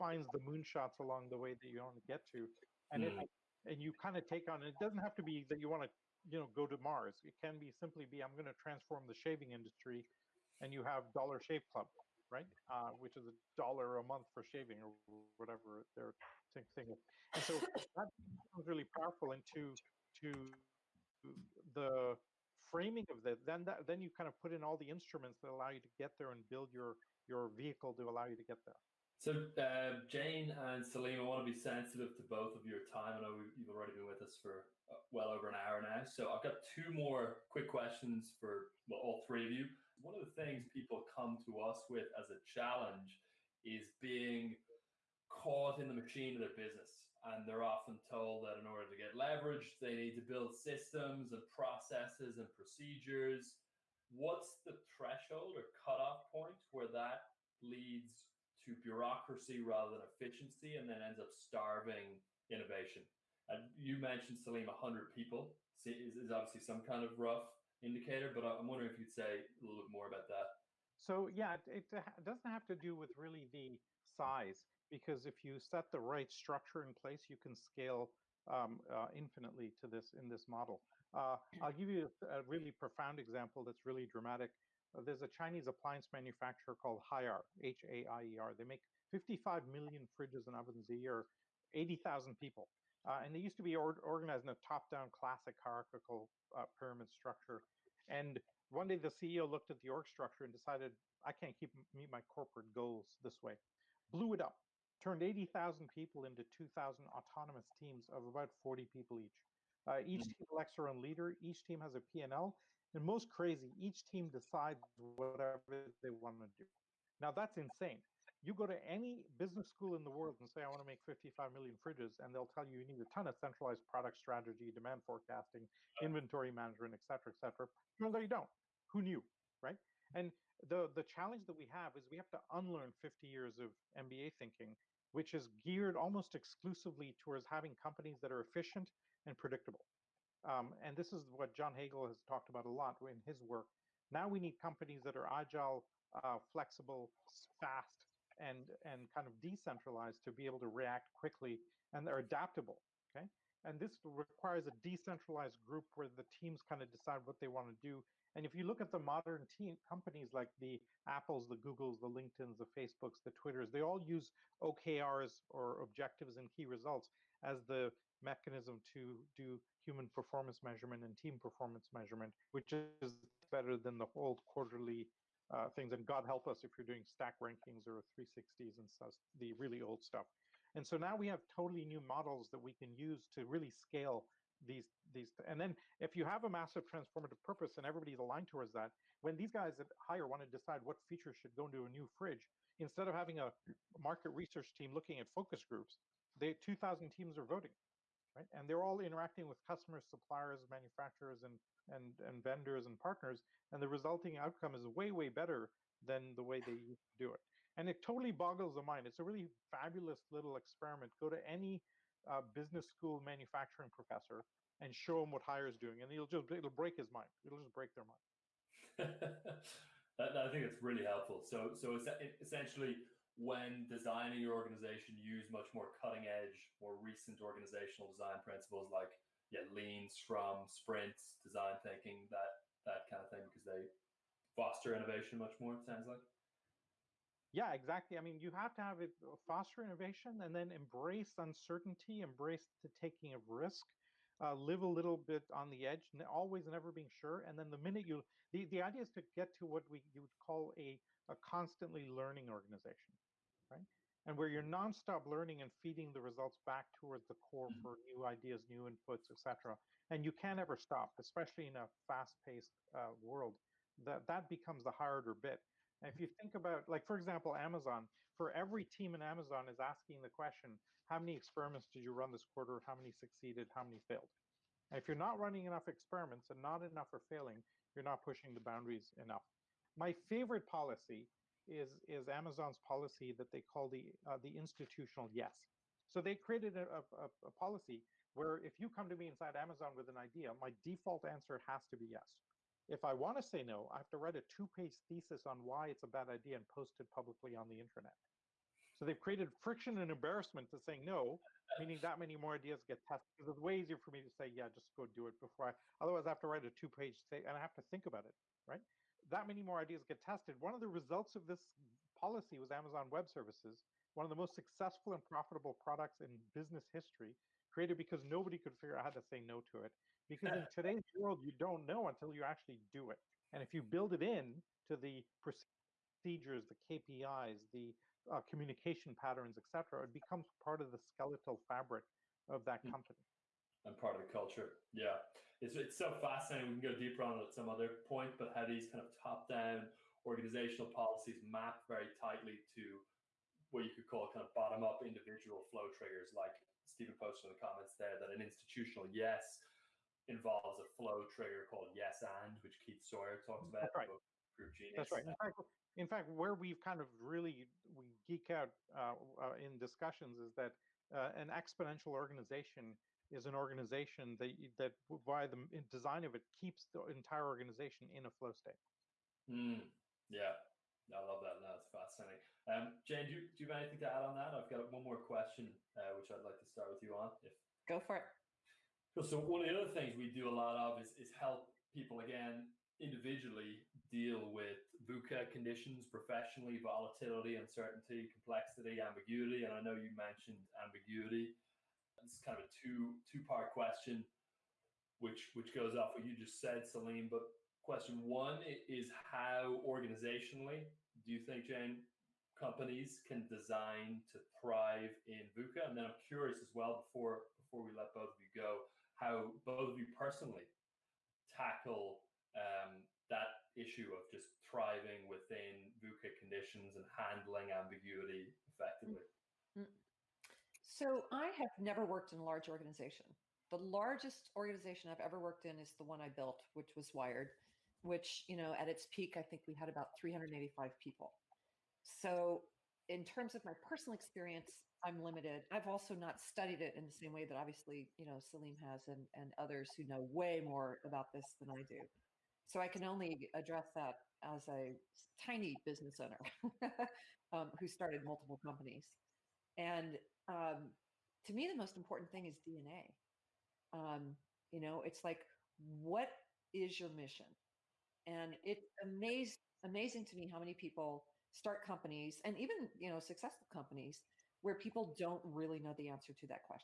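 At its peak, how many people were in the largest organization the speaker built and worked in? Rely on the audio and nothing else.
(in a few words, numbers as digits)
385.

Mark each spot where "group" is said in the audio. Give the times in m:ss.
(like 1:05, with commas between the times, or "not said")
2:35, 3:15, 5:54.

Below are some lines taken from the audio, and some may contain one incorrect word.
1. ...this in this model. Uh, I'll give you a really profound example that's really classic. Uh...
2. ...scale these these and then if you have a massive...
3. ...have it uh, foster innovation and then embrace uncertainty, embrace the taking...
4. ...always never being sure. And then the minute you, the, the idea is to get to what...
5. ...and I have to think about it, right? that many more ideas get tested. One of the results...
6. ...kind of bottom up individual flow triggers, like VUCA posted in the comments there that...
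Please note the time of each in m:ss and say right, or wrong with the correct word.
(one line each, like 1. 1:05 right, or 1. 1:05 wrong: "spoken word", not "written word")
1. 1:19 wrong: "dramatic", not "classic"
2. 3:03 right
3. 3:58 right
4. 4:06 right
5. 5:07 right
6. 5:44 wrong: "Steven", not "VUCA".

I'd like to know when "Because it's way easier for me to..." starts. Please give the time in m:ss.
5:03.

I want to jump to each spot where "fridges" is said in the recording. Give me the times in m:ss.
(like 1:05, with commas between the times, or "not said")
1:30, 2:01, 3:12.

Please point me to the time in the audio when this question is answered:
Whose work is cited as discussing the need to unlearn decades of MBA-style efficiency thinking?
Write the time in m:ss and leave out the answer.
2:21.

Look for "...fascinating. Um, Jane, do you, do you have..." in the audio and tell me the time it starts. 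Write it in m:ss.
6:11.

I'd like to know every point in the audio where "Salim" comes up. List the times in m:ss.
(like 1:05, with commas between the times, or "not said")
0:30, 1:04, 6:36, 7:18.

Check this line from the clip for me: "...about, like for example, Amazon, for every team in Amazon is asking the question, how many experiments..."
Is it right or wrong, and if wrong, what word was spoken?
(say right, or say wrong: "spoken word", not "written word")
right.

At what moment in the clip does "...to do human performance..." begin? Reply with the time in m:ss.
2:48.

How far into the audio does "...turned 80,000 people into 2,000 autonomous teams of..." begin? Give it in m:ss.
1:45.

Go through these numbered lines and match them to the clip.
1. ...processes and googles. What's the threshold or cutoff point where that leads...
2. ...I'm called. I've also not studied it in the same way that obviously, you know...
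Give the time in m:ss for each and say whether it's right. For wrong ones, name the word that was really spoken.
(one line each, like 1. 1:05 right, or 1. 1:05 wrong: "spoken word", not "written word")
1. 0:51 wrong: "procedures", not "googles"
2. 7:15 wrong: "limited", not "called".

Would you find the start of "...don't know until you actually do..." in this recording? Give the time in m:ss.
5:21.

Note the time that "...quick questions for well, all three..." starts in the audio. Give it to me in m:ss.
0:37.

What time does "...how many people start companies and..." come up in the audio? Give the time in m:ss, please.
7:40.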